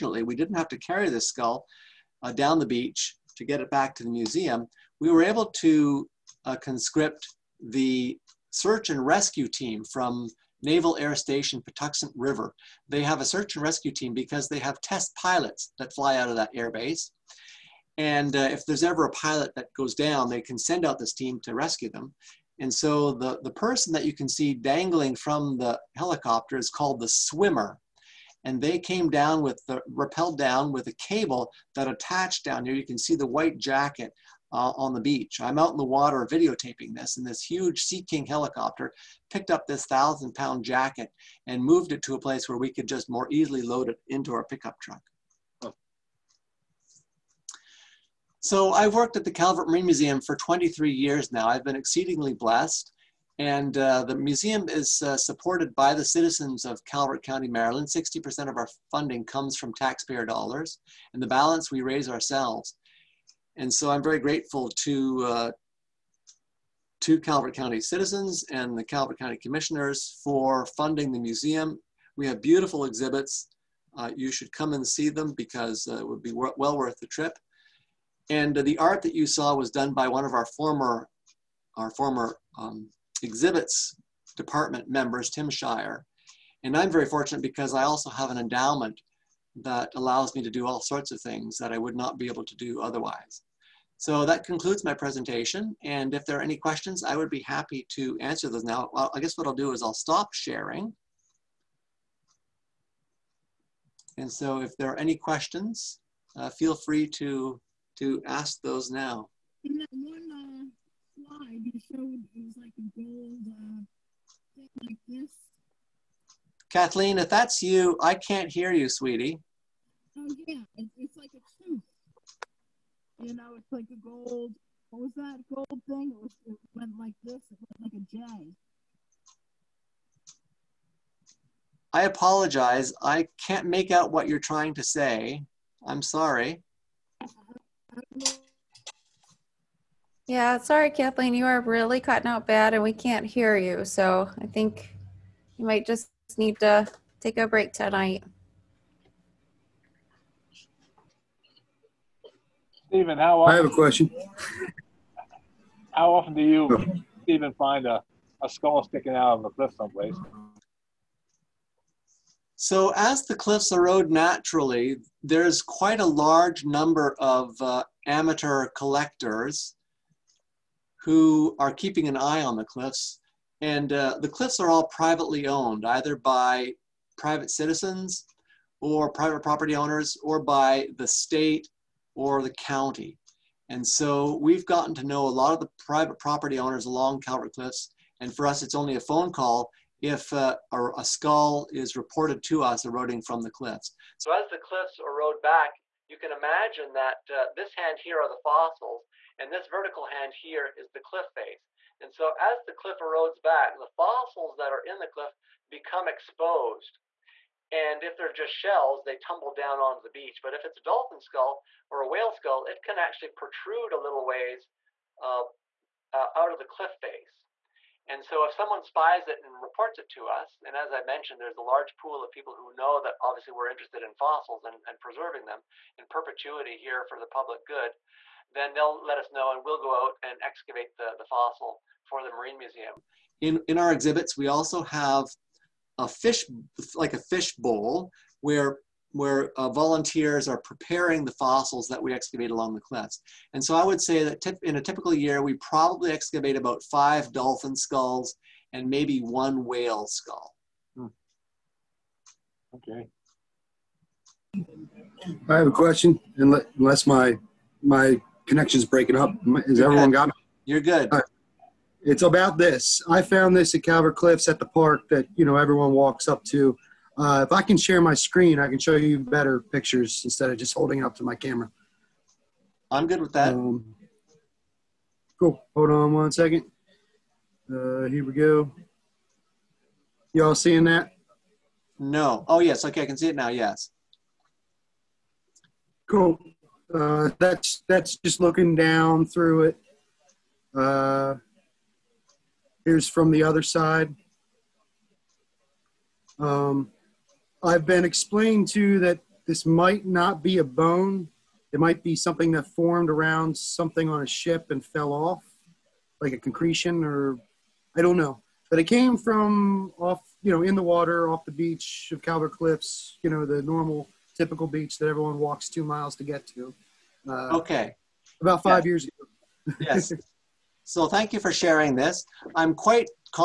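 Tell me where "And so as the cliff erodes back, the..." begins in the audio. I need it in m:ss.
3:22.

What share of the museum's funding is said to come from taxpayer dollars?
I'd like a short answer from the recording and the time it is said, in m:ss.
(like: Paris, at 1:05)
60%, at 0:57.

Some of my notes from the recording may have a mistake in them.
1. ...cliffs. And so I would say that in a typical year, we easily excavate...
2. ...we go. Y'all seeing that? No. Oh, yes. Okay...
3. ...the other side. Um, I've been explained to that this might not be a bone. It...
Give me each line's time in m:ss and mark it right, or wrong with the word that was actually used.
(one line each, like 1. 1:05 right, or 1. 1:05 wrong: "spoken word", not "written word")
1. 4:02 wrong: "probably", not "easily"
2. 4:38 right
3. 4:53 right.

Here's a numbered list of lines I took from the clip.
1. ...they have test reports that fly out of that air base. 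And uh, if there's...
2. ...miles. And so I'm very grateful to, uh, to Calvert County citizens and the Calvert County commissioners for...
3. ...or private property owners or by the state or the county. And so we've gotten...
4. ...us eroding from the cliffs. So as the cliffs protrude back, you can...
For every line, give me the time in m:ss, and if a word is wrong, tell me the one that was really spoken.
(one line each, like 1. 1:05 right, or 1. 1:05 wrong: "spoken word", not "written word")
1. 0:14 wrong: "pilots", not "reports"
2. 1:02 wrong: "ourselves", not "miles"
3. 2:58 right
4. 3:12 wrong: "erode", not "protrude".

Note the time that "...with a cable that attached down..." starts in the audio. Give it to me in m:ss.
0:30.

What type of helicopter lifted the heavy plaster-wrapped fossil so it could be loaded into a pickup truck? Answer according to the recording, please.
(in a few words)
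Sea King.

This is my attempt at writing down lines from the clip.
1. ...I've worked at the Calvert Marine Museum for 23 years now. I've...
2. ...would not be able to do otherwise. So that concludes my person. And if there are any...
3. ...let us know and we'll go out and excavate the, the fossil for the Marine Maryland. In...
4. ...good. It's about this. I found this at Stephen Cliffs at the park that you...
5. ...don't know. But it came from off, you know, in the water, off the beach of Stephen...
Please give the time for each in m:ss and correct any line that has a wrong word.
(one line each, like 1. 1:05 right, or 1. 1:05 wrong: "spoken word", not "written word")
1. 0:48 right
2. 1:31 wrong: "presentation", not "person"
3. 3:49 wrong: "Museum", not "Maryland"
4. 4:20 wrong: "Calvert", not "Stephen"
5. 5:08 wrong: "Calvert", not "Stephen".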